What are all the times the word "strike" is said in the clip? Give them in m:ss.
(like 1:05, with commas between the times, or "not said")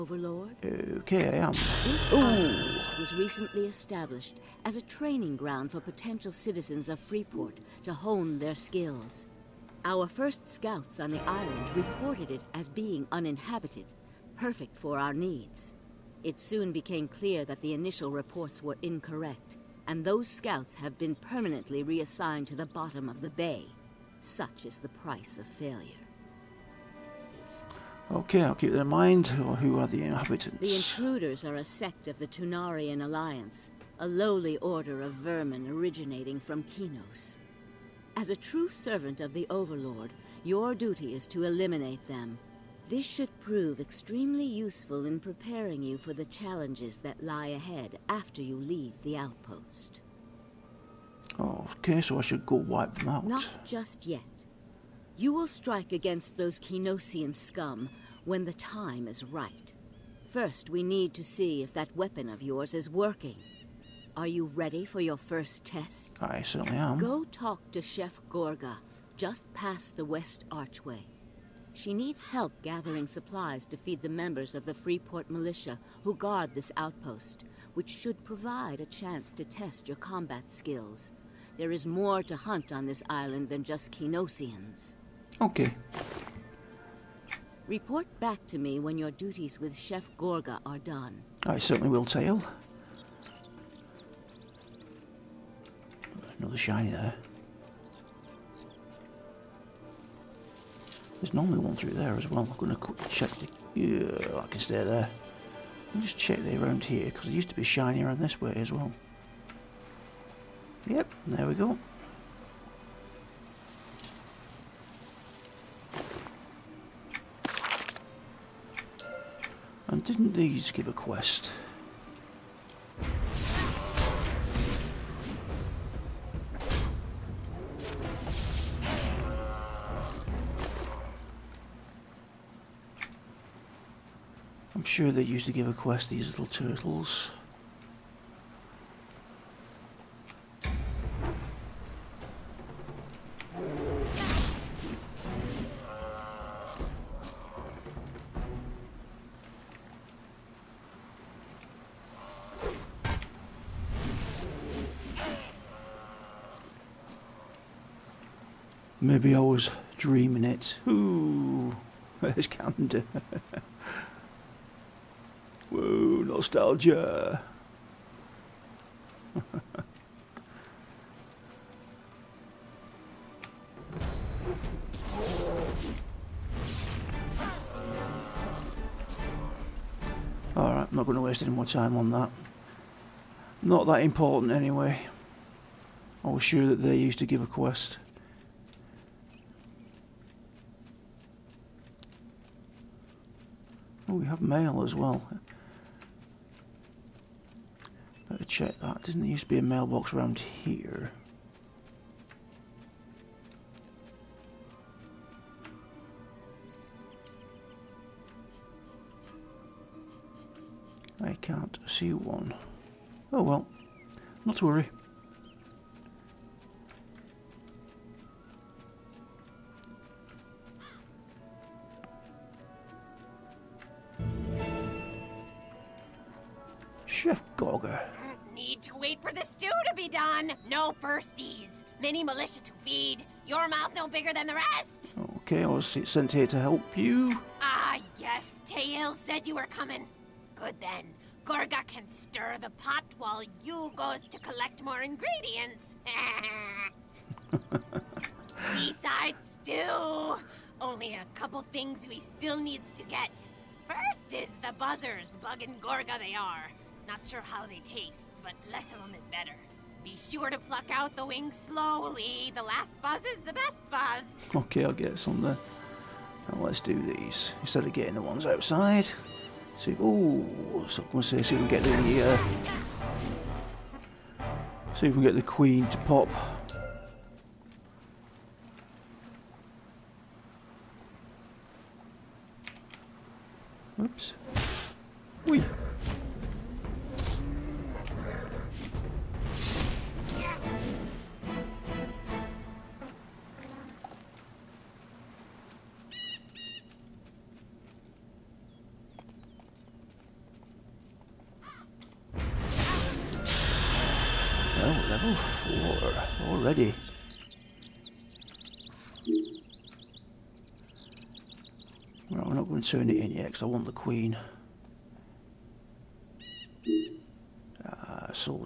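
0:55.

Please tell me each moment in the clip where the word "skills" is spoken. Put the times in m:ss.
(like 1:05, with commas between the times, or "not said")
0:08, 1:20.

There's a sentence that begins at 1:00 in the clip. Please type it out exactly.
First, we need to see if that weapon of yours is working.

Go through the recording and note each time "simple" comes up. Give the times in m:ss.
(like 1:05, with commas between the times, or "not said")
not said.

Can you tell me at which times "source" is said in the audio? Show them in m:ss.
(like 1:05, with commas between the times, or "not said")
not said.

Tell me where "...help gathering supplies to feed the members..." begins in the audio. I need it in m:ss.
1:12.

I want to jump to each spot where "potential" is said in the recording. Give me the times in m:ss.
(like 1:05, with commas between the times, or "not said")
0:05.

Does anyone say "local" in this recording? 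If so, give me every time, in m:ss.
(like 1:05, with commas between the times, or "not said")
not said.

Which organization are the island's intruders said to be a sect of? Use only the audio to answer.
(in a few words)
Tunarian Alliance.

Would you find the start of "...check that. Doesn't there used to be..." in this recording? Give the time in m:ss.
3:18.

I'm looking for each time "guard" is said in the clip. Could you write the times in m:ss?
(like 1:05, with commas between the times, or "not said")
1:16.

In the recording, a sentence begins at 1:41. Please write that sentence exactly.
There's normally one through there as well.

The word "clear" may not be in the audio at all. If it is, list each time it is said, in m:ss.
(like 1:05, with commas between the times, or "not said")
0:17.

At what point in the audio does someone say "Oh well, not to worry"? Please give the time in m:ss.
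3:33.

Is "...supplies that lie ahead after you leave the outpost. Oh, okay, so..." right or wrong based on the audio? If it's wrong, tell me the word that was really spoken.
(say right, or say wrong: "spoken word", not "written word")
wrong: "challenges", not "supplies".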